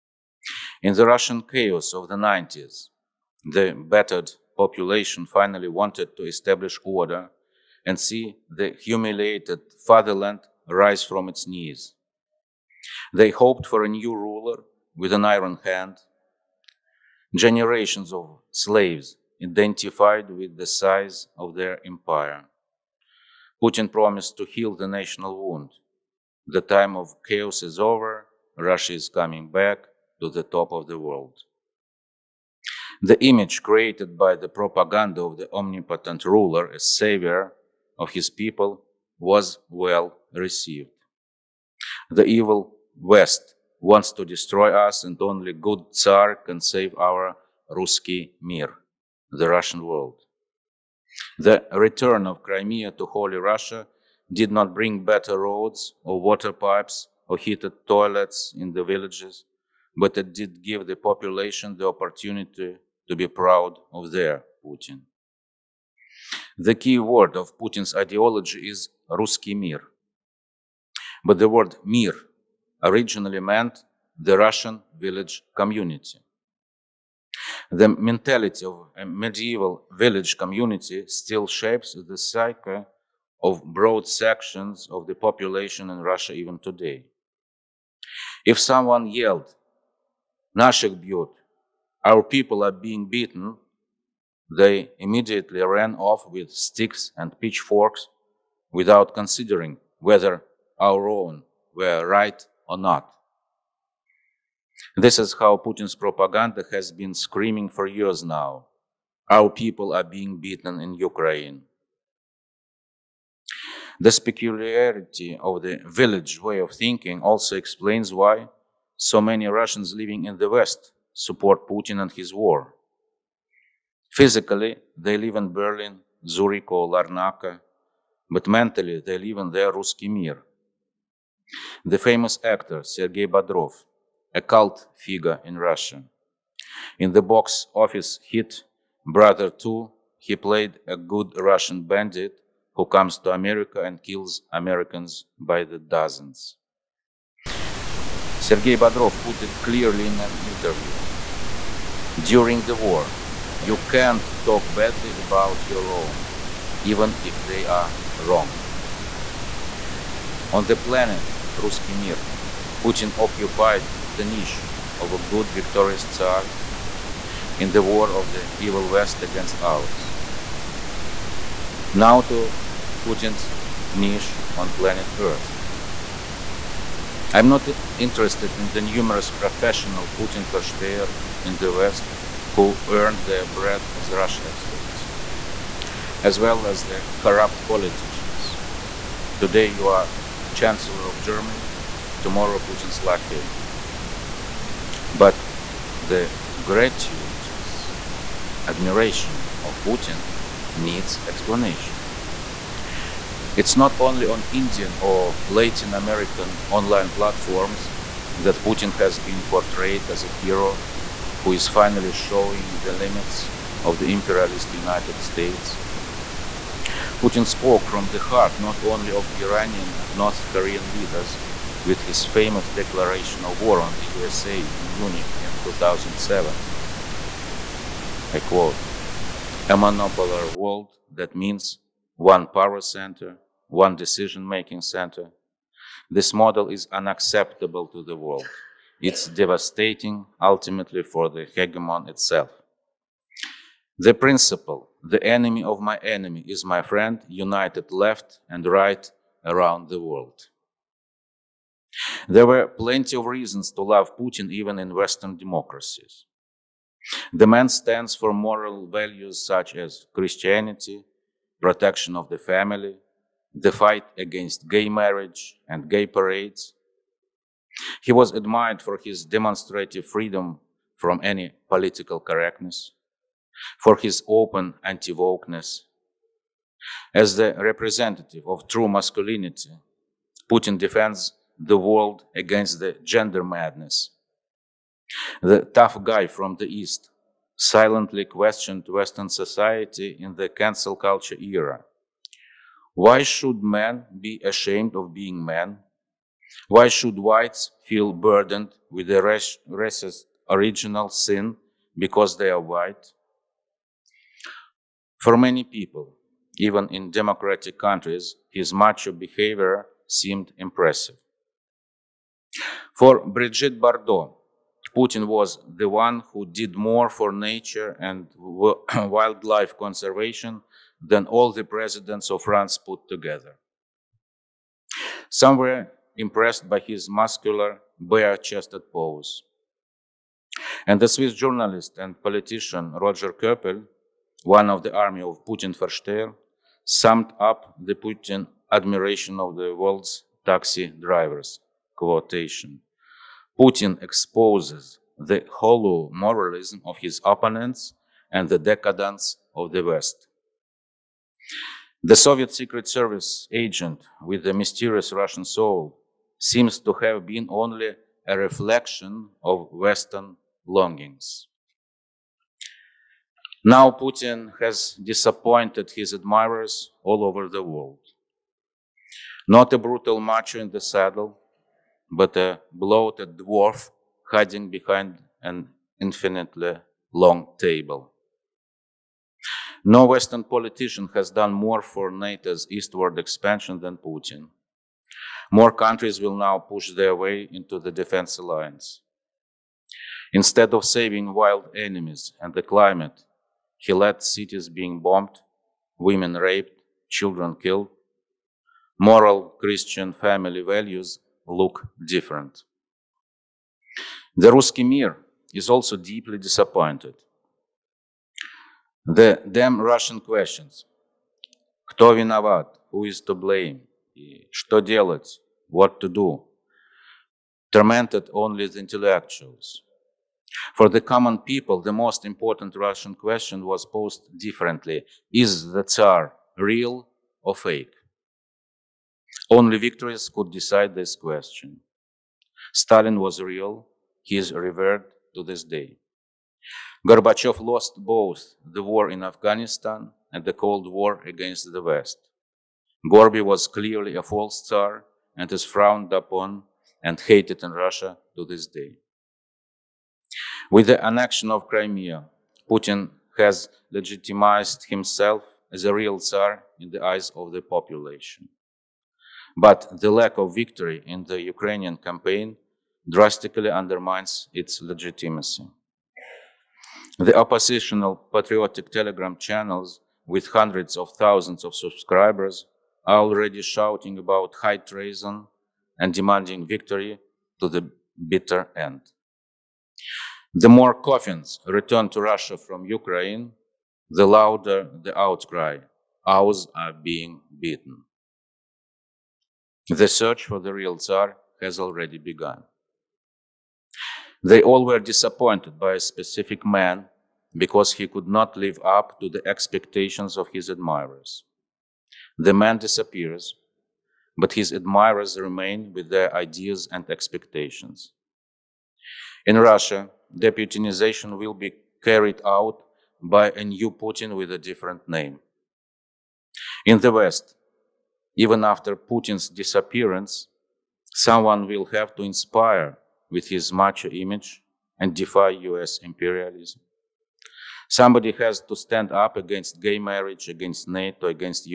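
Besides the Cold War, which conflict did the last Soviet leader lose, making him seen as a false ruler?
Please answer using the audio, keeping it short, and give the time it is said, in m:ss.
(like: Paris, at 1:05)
war in Afghanistan, at 7:18.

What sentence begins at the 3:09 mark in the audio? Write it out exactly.
Today you are Chancellor of Germany, tomorrow Putin's lucky.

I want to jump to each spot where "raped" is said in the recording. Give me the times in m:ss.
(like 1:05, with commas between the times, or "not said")
6:36.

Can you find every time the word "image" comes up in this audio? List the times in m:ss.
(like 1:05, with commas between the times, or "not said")
0:33, 8:44.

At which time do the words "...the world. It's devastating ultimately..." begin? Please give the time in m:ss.
3:58.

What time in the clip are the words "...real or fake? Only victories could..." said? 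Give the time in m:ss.
7:06.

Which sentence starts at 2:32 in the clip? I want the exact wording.
During the war, you can't talk badly about your own, even if they are wrong.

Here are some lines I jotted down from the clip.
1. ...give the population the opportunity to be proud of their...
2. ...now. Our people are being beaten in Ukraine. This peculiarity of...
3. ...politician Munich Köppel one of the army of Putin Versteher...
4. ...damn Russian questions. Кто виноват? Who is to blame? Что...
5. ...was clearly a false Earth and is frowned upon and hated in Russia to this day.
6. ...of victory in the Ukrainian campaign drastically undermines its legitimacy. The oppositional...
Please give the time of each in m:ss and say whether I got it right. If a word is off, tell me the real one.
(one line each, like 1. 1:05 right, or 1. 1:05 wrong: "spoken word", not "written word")
1. 1:00 right
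2. 1:48 right
3. 5:32 wrong: "Roger", not "Munich"
4. 6:49 right
5. 7:23 wrong: "Tsar", not "Earth"
6. 7:40 right.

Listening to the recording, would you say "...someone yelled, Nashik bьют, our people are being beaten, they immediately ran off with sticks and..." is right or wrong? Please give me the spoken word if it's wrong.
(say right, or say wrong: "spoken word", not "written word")
right.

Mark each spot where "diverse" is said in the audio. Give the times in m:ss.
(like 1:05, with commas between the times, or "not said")
not said.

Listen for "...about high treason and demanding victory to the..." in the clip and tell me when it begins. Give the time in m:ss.
7:54.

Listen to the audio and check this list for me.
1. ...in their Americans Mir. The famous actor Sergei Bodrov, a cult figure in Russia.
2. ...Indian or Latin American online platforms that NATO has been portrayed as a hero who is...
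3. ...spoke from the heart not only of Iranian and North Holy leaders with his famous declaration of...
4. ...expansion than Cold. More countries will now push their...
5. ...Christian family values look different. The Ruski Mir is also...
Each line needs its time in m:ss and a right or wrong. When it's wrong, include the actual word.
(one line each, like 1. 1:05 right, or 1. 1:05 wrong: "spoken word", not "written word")
1. 2:09 wrong: "Ruski", not "Americans"
2. 3:24 wrong: "Putin", not "NATO"
3. 3:37 wrong: "Korean", not "Holy"
4. 6:23 wrong: "Putin", not "Cold"
5. 6:39 right.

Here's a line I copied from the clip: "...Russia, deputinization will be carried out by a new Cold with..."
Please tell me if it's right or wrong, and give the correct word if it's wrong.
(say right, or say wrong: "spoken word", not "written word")
wrong: "Putin", not "Cold".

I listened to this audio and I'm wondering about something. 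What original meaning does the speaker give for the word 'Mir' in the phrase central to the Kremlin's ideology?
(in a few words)
Russian village community.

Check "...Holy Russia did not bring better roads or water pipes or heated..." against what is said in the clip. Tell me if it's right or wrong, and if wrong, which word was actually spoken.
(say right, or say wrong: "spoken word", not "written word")
right.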